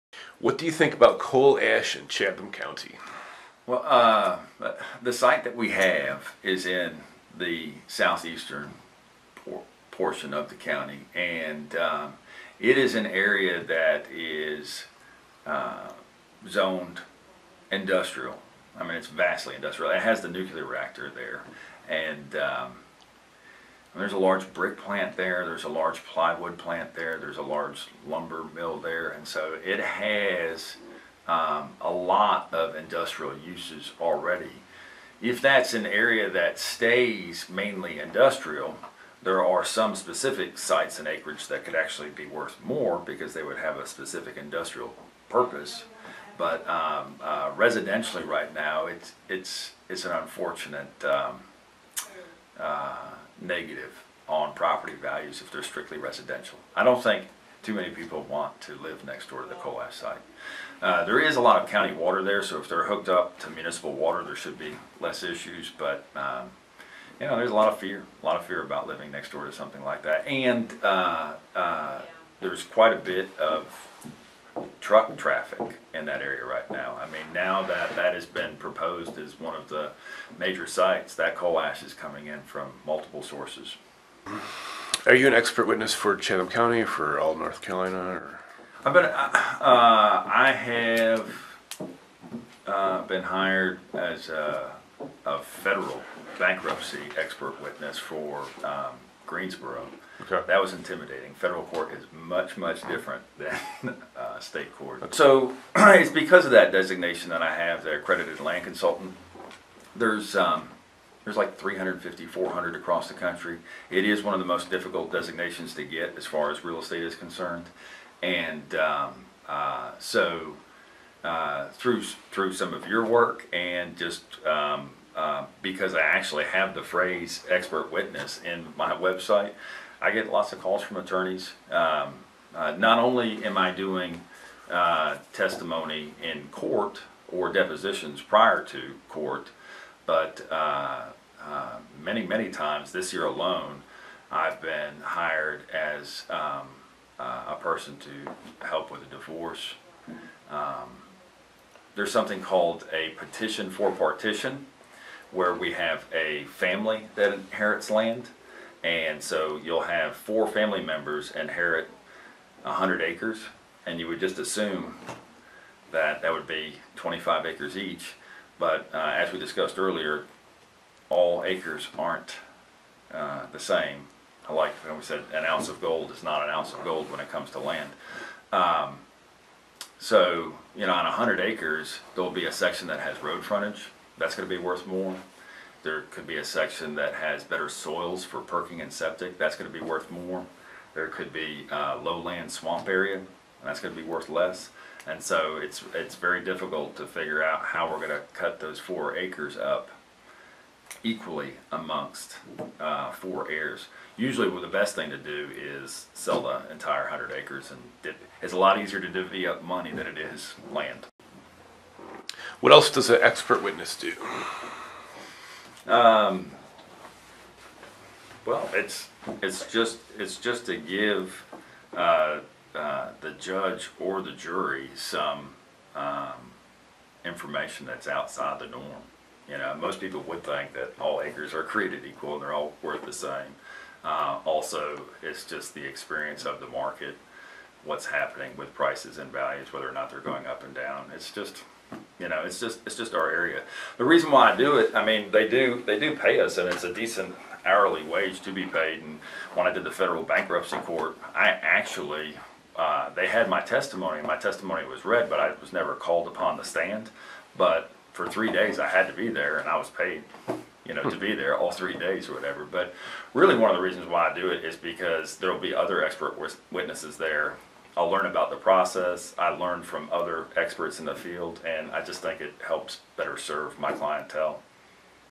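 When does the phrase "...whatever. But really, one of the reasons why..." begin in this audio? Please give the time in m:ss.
4:22.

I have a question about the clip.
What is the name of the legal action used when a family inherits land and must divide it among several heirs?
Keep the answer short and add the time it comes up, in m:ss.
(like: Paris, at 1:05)
Petition for partition, at 2:33.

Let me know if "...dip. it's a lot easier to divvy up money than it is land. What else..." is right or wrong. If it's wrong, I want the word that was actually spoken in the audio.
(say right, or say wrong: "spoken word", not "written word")
right.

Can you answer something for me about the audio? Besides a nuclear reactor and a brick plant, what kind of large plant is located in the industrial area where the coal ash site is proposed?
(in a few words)
Plywood plant.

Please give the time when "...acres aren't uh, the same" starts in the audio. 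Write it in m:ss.
2:51.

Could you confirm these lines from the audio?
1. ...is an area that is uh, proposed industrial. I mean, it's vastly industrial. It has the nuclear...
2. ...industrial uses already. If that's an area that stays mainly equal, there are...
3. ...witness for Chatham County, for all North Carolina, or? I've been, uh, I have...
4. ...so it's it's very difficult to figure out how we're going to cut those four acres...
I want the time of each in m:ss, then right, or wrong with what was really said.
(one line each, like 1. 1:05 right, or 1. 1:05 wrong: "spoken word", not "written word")
1. 0:12 wrong: "zoned", not "proposed"
2. 0:32 wrong: "industrial", not "equal"
3. 1:25 right
4. 3:15 right.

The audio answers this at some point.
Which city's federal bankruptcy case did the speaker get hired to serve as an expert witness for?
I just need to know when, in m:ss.
1:39.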